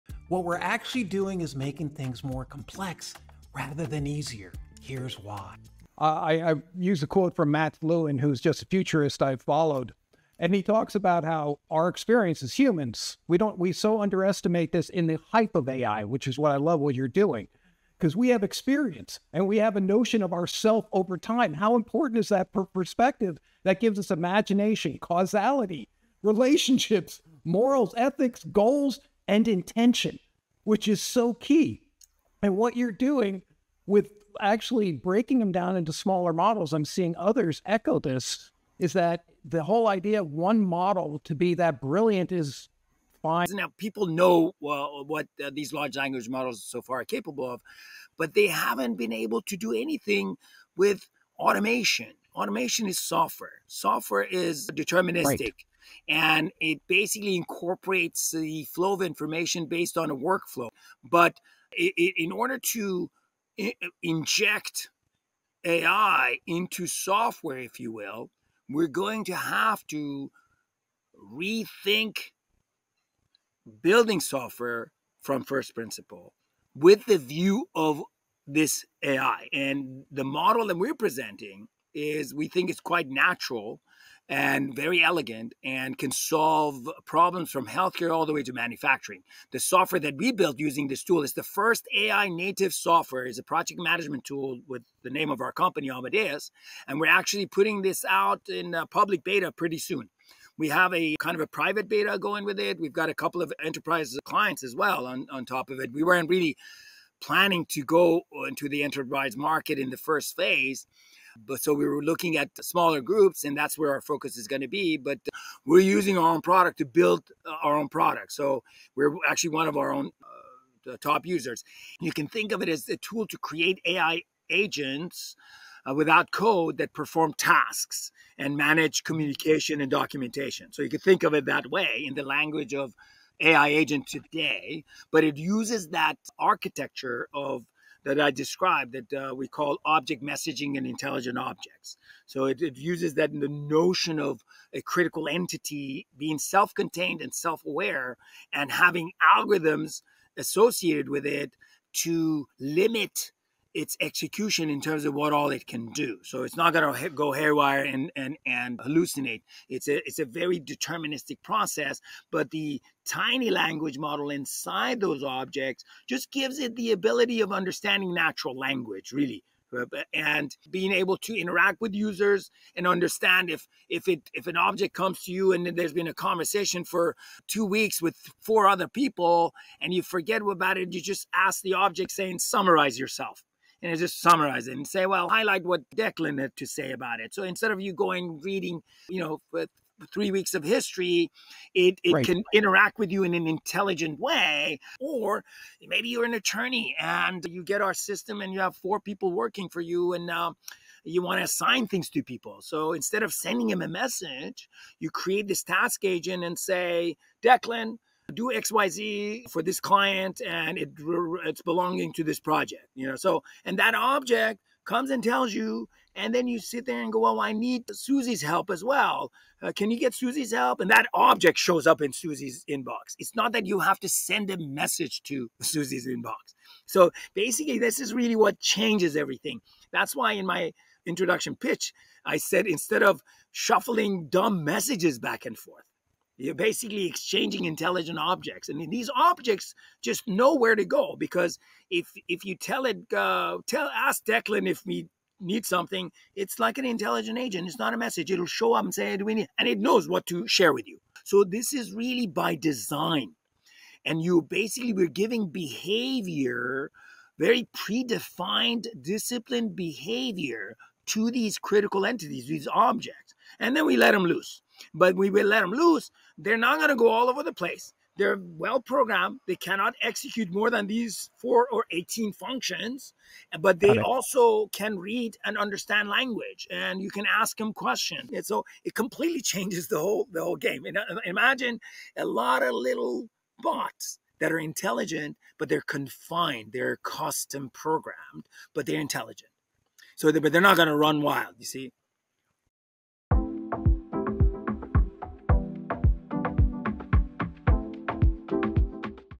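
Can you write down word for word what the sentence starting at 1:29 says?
The software that we built using this tool is the first AI native software.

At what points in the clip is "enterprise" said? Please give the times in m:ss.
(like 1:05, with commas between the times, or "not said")
1:43, 1:48.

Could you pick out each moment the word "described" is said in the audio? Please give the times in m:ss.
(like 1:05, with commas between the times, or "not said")
2:18.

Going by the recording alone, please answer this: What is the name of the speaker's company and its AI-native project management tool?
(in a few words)
Amadeus.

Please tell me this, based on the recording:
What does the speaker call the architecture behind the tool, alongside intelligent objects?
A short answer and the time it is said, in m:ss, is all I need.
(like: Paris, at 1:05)
object messaging, at 2:19.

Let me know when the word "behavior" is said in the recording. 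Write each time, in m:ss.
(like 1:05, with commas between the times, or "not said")
4:15, 4:19.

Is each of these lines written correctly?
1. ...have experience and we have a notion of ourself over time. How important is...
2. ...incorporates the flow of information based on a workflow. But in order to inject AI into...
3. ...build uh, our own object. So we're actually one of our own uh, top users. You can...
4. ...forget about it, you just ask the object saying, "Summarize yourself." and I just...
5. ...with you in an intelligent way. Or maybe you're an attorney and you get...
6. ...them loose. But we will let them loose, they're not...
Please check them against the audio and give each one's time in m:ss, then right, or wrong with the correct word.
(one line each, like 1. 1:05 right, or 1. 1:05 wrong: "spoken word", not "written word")
1. 0:18 right
2. 0:57 right
3. 1:56 wrong: "product", not "object"
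4. 3:00 right
5. 3:12 right
6. 4:24 right.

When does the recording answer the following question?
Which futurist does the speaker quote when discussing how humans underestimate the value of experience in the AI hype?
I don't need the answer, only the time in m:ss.
0:07.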